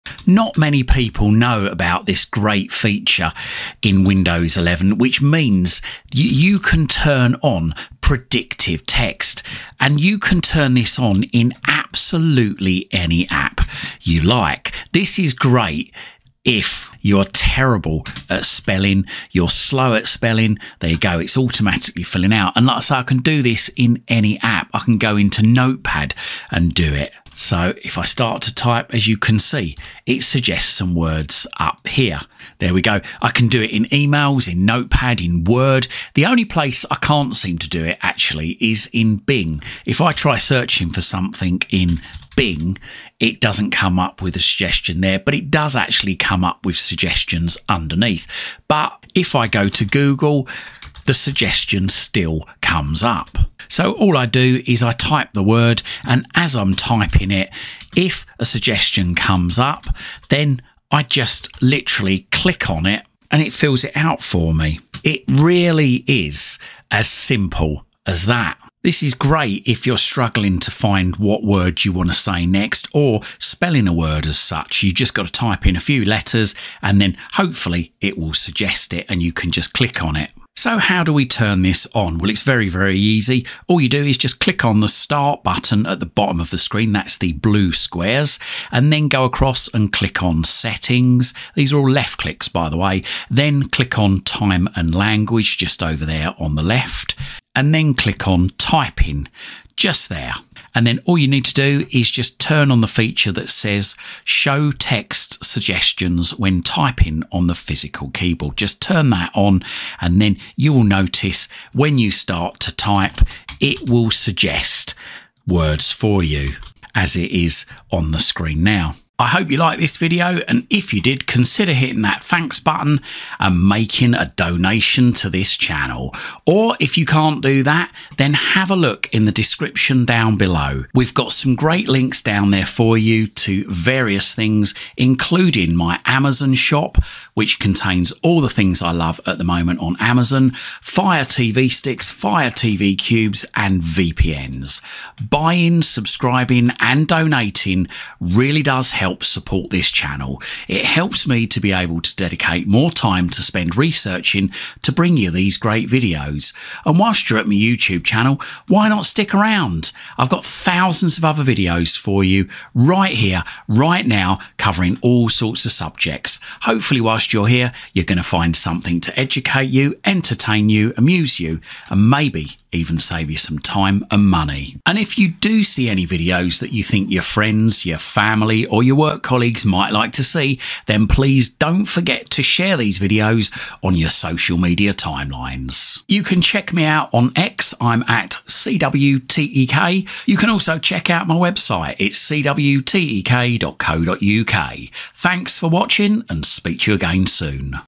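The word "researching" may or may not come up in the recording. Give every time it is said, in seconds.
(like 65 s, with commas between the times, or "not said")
153 s.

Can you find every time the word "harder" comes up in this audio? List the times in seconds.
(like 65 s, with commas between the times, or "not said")
not said.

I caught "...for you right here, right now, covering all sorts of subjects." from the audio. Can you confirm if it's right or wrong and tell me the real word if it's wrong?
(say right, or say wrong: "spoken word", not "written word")
right.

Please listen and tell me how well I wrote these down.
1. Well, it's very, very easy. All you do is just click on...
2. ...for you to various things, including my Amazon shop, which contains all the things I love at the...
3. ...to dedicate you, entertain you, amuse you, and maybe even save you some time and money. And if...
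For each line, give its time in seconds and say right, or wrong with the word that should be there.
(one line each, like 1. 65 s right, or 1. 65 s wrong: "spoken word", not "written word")
1. 82 s right
2. 132 s right
3. 169 s wrong: "educate", not "dedicate".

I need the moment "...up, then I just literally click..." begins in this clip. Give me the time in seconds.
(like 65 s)
59 s.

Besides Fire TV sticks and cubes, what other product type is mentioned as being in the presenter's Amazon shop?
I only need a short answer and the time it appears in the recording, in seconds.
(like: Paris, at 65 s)
VPNs, at 143 s.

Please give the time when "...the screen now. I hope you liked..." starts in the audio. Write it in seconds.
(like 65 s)
118 s.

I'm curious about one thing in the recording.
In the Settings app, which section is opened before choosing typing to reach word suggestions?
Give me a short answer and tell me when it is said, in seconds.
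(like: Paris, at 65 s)
Time and language, at 94 s.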